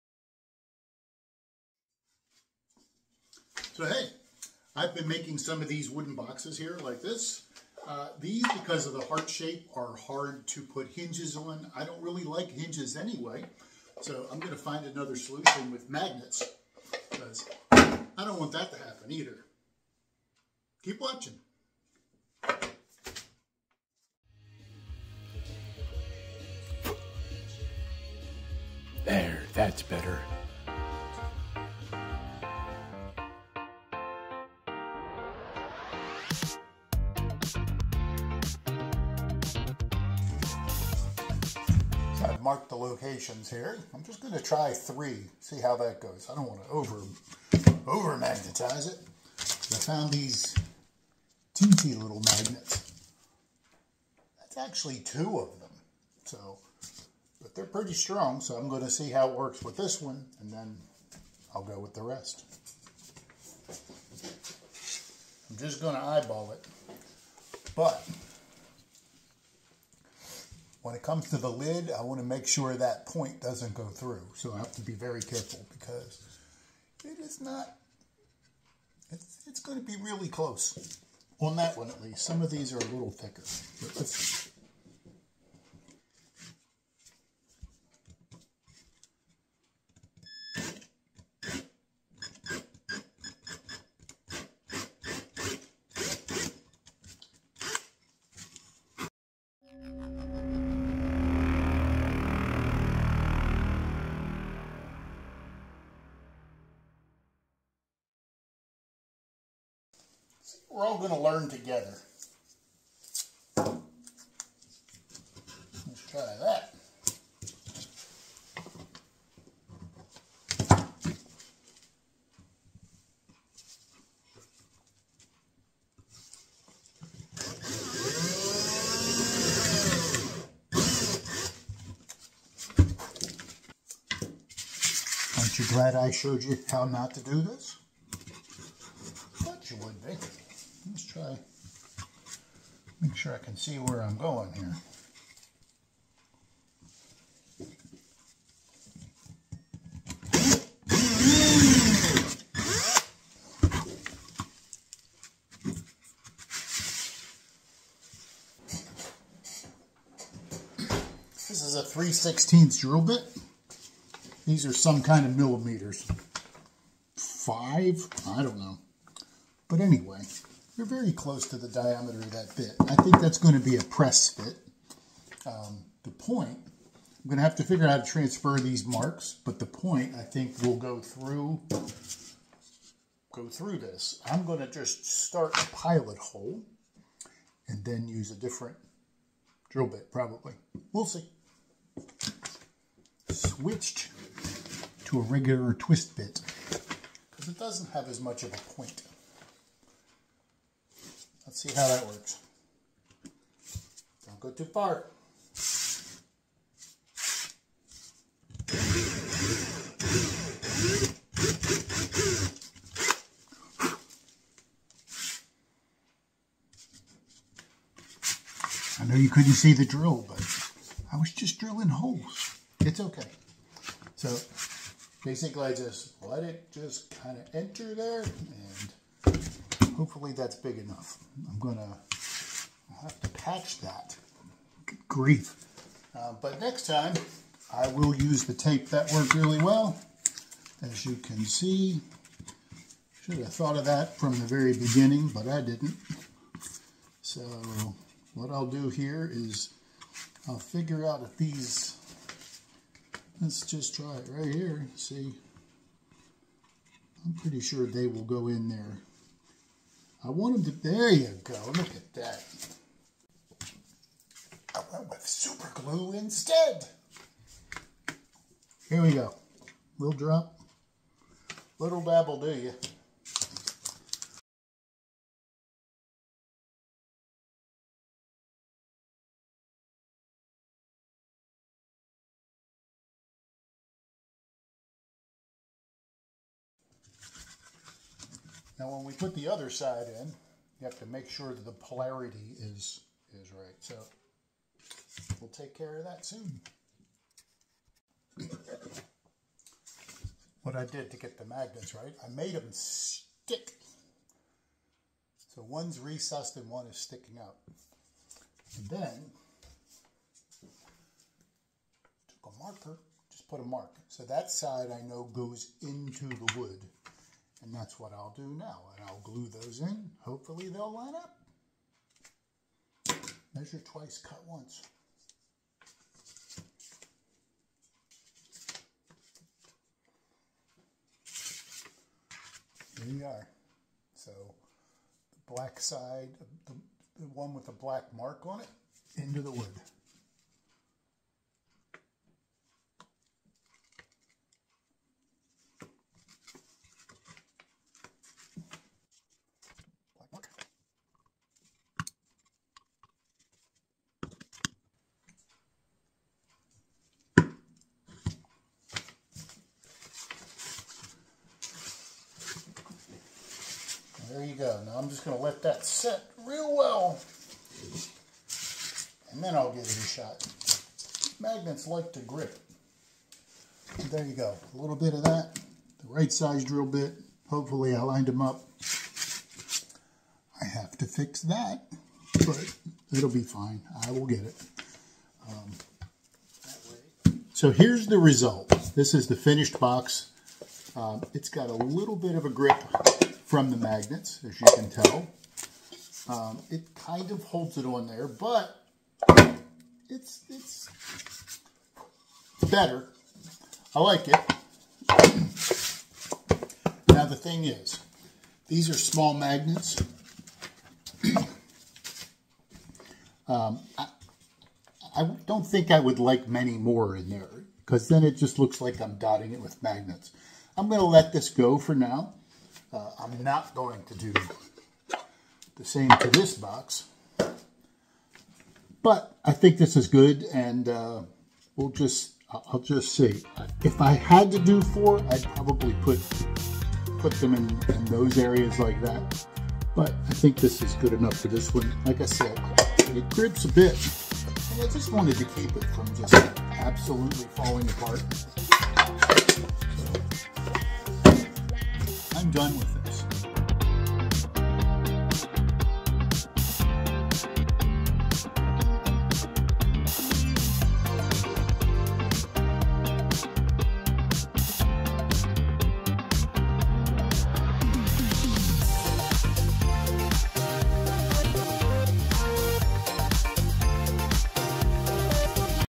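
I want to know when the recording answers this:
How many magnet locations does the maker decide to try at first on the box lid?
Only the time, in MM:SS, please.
00:44.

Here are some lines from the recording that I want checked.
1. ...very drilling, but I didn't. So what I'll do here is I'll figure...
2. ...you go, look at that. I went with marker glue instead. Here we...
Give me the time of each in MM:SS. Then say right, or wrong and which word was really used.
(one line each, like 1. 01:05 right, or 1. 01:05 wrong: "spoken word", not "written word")
1. 04:04 wrong: "beginning", not "drilling"
2. 04:21 wrong: "super", not "marker".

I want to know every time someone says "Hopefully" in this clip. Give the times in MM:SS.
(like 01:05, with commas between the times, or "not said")
03:50, 05:20, 06:17.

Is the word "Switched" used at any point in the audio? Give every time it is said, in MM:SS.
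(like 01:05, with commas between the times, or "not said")
03:13.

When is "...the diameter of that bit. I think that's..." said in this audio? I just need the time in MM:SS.
02:51.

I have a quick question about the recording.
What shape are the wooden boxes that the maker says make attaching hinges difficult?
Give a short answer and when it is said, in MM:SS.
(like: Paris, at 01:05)
Heart, at 00:09.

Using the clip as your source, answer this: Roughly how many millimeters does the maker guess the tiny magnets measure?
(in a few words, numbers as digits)
5.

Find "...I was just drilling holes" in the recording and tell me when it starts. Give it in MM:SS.
03:41.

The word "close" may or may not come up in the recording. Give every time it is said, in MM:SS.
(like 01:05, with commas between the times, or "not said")
01:20, 02:51.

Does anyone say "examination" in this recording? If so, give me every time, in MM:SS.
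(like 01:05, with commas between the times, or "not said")
not said.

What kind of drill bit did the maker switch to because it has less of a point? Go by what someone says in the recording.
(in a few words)
Twist bit.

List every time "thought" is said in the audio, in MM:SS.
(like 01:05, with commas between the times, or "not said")
02:19, 04:03.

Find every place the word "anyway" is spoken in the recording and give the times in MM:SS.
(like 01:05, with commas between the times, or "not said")
00:12, 02:49.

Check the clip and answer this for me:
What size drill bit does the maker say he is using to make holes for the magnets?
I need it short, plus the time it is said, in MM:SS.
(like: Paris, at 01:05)
3/16, at 02:41.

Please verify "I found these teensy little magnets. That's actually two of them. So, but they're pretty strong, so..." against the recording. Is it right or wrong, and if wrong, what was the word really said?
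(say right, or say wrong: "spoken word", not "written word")
right.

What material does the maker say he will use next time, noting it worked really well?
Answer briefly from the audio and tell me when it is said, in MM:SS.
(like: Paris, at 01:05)
Tape, at 03:58.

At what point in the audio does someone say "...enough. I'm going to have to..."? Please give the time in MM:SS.
03:50.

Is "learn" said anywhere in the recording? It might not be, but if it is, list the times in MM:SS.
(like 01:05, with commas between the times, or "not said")
01:51.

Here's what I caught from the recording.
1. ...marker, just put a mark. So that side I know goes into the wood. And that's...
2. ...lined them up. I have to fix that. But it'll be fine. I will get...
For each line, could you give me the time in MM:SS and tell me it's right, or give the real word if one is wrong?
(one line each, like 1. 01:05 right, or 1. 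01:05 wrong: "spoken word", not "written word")
1. 05:12 right
2. 06:18 right.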